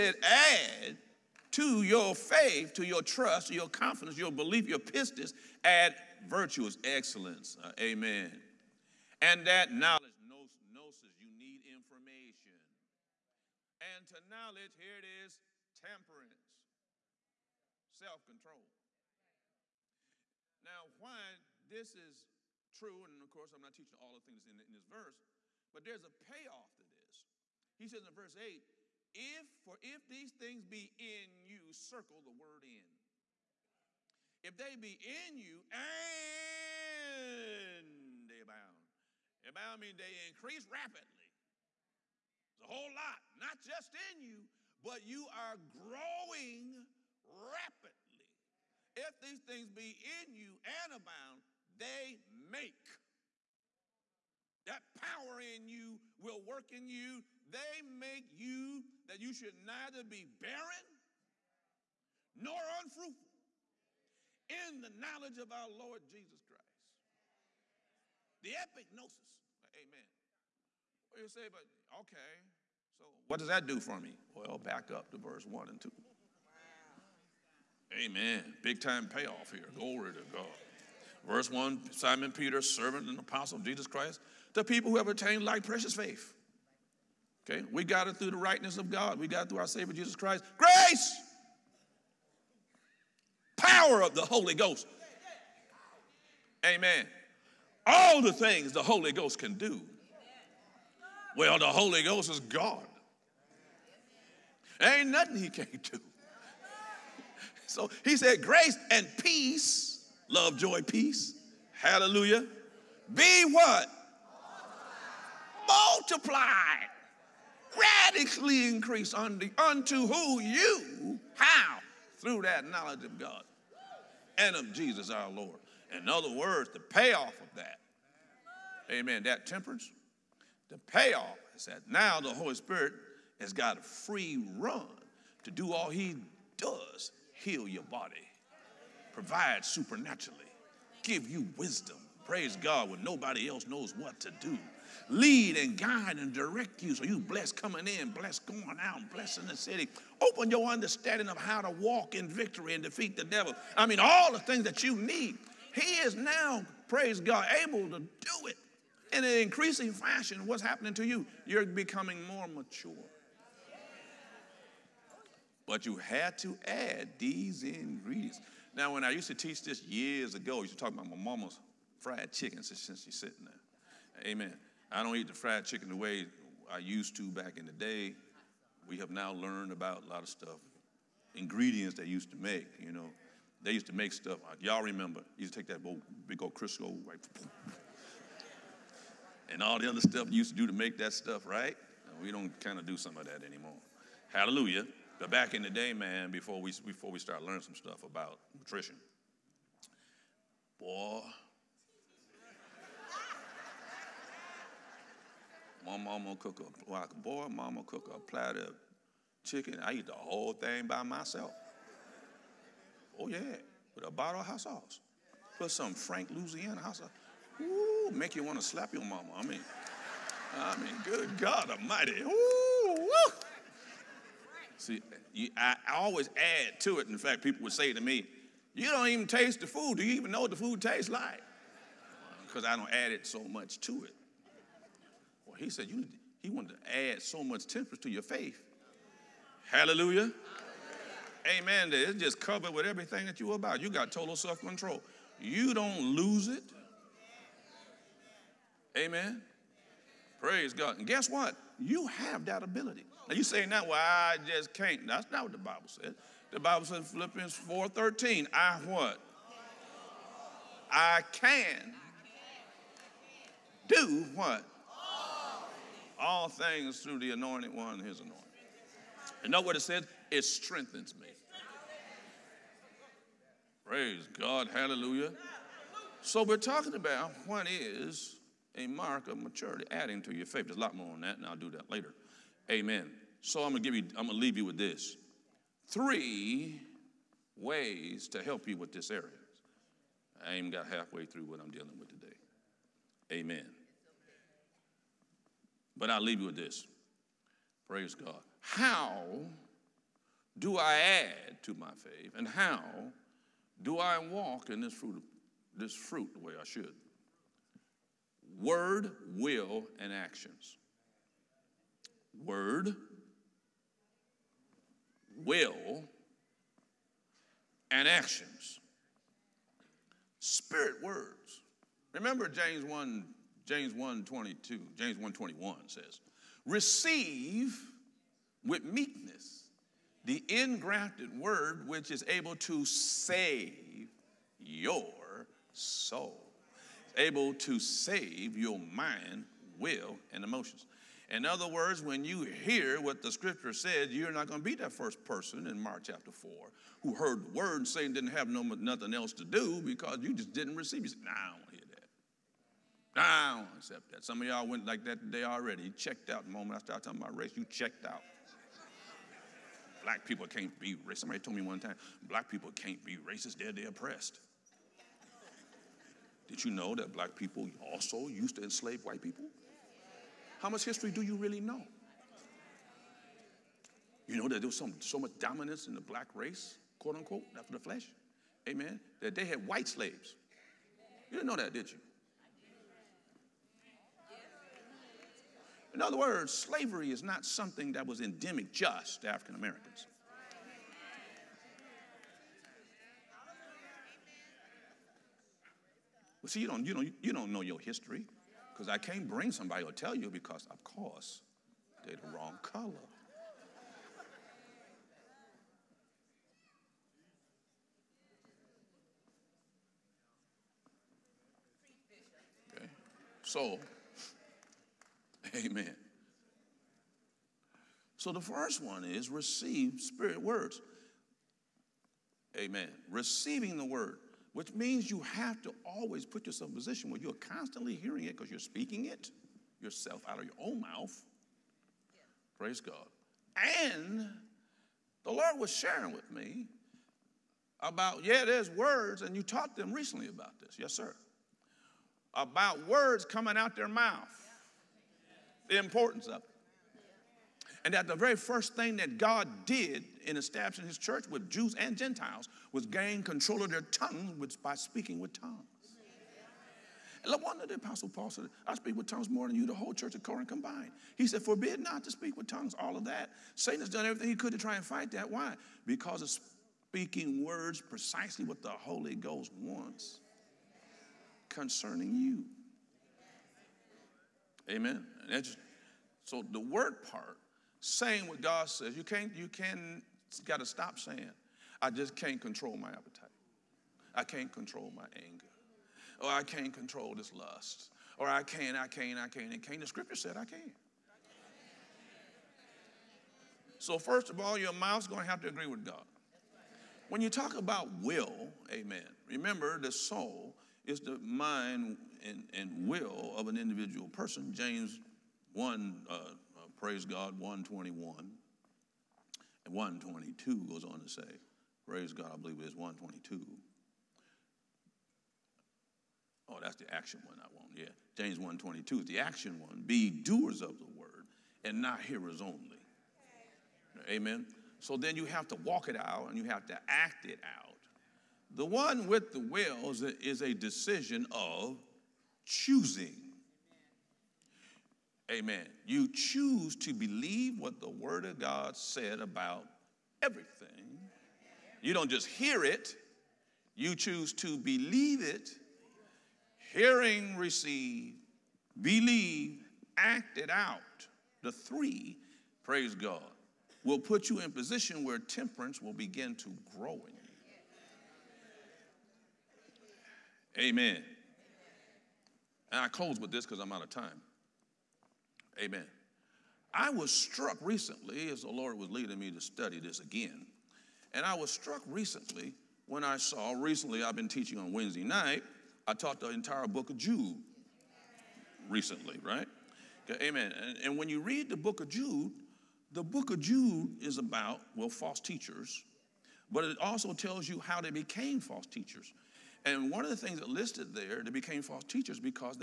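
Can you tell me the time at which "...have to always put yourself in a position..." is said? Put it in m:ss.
7:05.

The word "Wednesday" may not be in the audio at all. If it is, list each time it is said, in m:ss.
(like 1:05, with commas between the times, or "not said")
9:34.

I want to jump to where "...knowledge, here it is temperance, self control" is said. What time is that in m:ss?
0:14.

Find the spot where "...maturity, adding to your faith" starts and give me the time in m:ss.
4:39.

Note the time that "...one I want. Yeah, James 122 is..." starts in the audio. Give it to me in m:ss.
8:37.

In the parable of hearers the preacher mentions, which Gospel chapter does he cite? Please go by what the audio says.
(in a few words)
Mark chapter 4.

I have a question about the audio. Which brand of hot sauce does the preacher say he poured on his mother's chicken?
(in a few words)
Frank Louisiana.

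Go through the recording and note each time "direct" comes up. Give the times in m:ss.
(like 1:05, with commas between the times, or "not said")
2:26.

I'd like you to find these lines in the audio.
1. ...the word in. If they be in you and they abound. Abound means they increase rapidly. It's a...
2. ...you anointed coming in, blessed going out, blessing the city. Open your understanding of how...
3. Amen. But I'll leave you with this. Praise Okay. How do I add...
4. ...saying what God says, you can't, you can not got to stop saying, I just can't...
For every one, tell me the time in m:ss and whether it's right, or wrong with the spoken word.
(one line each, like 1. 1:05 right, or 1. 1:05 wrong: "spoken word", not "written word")
1. 0:32 right
2. 2:27 wrong: "blessed", not "anointed"
3. 4:53 wrong: "God", not "Okay"
4. 7:57 right.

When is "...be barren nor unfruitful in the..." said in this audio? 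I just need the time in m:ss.
1:00.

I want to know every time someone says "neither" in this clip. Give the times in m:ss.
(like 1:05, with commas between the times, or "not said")
0:59.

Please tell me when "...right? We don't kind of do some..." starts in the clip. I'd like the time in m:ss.
3:11.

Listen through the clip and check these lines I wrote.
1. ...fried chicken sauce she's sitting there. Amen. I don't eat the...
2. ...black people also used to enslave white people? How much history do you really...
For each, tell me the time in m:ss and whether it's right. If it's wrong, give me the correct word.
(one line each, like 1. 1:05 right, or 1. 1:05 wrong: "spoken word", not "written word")
1. 2:51 wrong: "since", not "sauce"
2. 6:07 right.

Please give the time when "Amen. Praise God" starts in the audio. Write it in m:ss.
4:08.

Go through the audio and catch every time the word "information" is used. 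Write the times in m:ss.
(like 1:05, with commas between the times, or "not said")
0:11.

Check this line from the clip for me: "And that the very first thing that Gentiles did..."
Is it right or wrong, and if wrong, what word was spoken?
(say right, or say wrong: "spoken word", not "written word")
wrong: "God", not "Gentiles".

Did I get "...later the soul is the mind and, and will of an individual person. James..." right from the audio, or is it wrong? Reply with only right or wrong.
wrong.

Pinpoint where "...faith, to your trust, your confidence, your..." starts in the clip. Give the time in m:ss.
0:02.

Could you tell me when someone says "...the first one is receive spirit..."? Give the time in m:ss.
6:58.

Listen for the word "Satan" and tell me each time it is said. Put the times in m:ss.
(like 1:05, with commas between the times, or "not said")
7:43.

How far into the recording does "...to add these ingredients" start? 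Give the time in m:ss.
2:46.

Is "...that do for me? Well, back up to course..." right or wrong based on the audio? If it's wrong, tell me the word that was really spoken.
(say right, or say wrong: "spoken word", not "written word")
wrong: "verse", not "course".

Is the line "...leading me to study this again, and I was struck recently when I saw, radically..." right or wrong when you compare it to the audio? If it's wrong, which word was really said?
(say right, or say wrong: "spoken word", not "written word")
wrong: "recently", not "radically".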